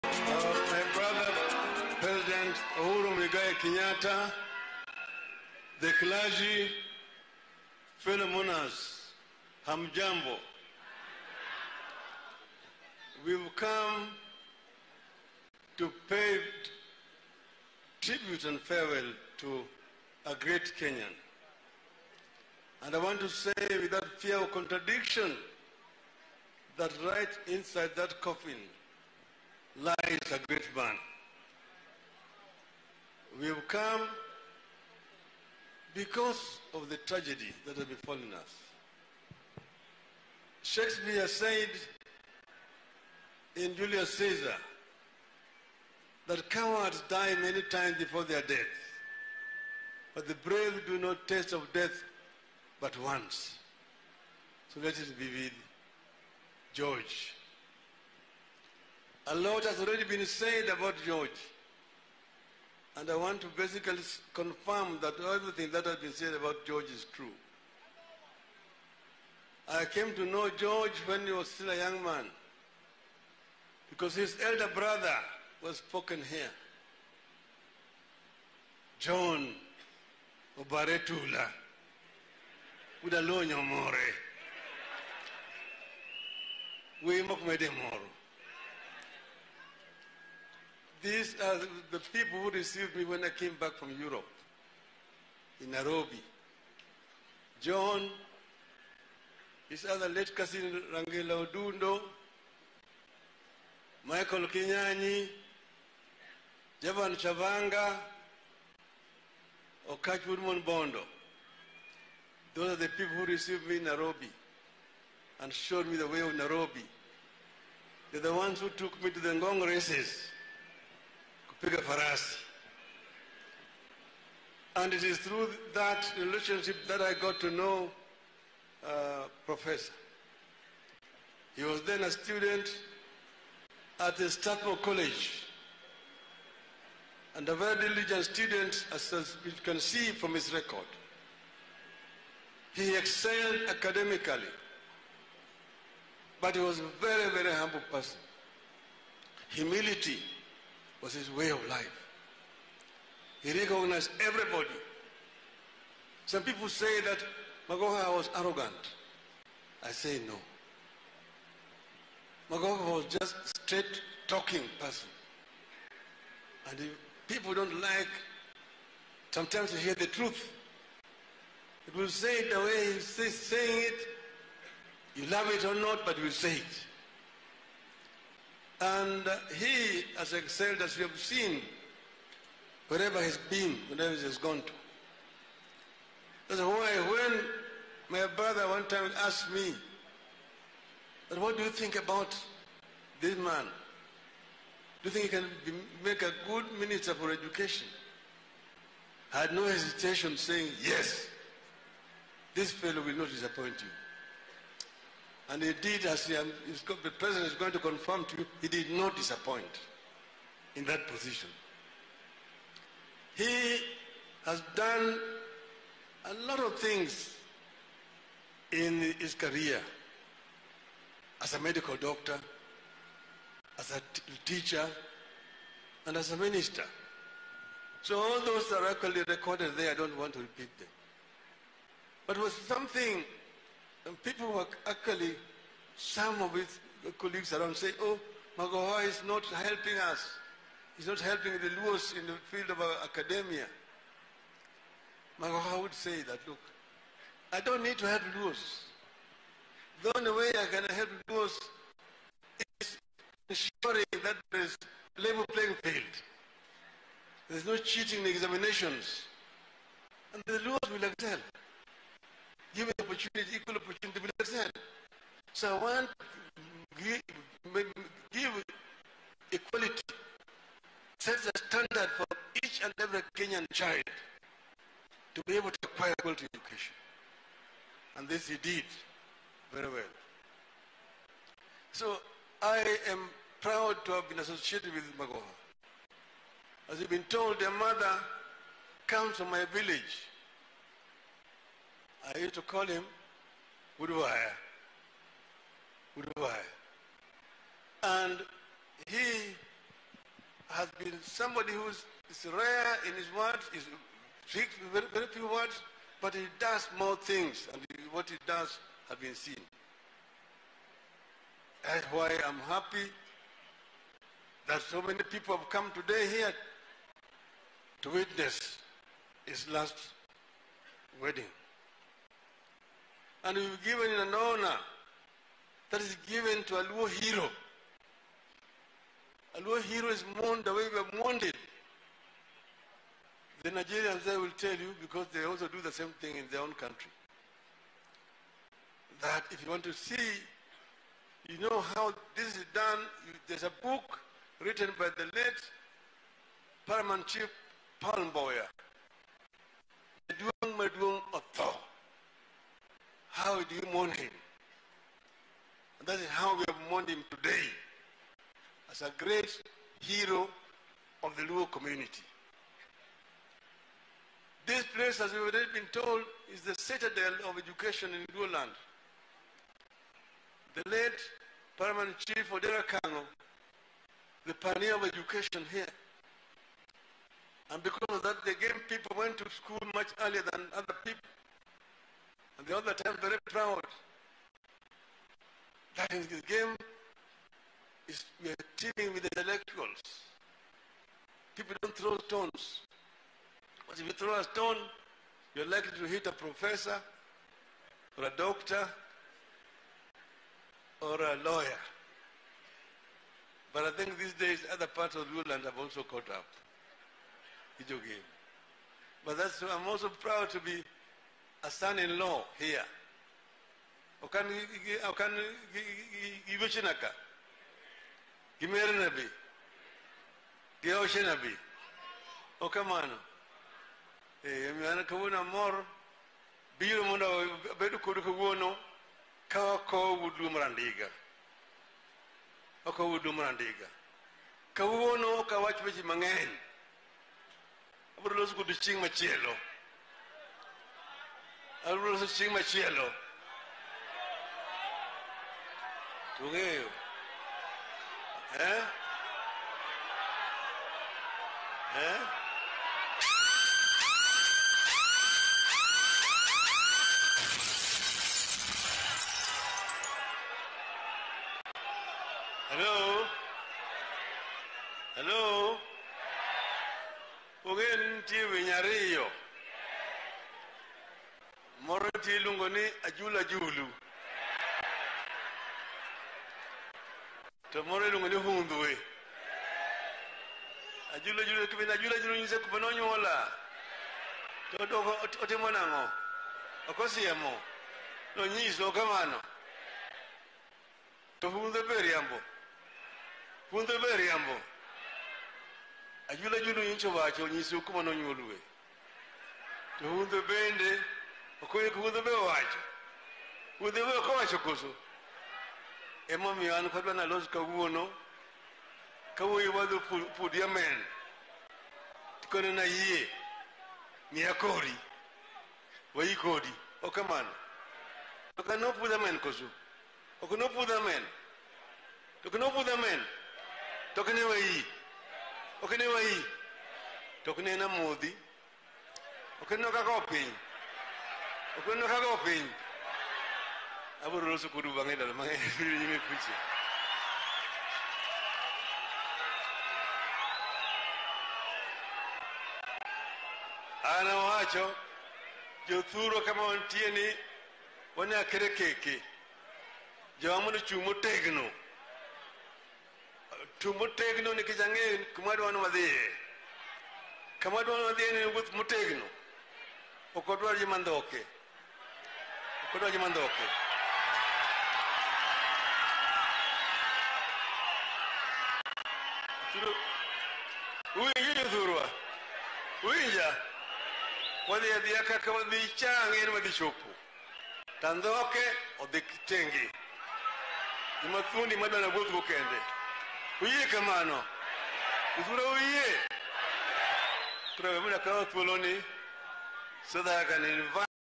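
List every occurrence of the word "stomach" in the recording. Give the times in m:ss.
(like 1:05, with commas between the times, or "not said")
not said.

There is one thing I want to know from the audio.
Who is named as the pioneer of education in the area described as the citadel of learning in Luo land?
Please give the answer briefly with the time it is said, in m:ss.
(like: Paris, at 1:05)
Odera Akang'o, at 6:12.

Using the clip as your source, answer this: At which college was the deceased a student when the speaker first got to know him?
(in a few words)
Strathmore College.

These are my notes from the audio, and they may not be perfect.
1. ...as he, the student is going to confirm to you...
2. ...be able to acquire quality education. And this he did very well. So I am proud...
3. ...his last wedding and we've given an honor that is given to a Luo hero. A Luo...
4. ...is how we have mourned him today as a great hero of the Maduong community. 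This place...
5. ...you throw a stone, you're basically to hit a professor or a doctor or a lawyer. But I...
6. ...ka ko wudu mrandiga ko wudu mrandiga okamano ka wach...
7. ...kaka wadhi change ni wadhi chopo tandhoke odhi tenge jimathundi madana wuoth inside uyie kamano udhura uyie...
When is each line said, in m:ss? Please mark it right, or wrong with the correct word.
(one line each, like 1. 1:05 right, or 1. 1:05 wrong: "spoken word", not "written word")
1. 3:26 wrong: "president", not "student"
2. 4:35 right
3. 5:19 right
4. 5:56 wrong: "Luo", not "Maduong"
5. 6:34 wrong: "likely", not "basically"
6. 7:09 wrong: "kawuono", not "okamano"
7. 9:35 wrong: "gokende", not "inside".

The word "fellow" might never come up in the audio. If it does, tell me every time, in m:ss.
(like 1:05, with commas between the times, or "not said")
3:22.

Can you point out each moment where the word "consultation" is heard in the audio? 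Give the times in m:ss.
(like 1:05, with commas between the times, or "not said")
not said.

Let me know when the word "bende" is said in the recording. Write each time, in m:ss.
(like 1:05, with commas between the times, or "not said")
8:20.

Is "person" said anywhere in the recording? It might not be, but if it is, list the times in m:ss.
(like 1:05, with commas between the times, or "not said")
2:27, 2:44.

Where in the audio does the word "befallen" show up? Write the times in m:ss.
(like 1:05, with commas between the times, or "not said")
0:37.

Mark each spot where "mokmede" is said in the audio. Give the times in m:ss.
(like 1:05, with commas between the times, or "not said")
1:27.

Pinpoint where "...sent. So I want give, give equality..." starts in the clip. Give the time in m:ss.
4:24.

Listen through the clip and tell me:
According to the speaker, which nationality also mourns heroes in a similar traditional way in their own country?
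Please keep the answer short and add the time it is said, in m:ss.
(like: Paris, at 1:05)
Nigerians, at 5:33.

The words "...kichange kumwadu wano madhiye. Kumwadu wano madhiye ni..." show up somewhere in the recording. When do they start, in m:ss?
9:14.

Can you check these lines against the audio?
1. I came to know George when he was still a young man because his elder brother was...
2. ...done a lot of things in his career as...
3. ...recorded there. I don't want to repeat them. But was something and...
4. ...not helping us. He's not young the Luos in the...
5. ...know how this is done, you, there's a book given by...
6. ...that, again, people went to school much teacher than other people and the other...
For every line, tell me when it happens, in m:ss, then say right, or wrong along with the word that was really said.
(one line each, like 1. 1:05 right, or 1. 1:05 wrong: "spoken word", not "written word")
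1. 1:09 right
2. 3:34 right
3. 3:49 right
4. 3:59 wrong: "helping", not "young"
5. 5:41 wrong: "written", not "given"
6. 6:18 wrong: "earlier", not "teacher".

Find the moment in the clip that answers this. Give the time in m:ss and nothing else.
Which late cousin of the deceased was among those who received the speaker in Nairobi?
1:40.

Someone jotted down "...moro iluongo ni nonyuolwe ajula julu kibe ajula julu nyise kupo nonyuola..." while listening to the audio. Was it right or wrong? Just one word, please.
wrong.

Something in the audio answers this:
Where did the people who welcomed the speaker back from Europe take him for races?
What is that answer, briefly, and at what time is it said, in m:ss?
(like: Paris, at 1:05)
Ngong, at 1:59.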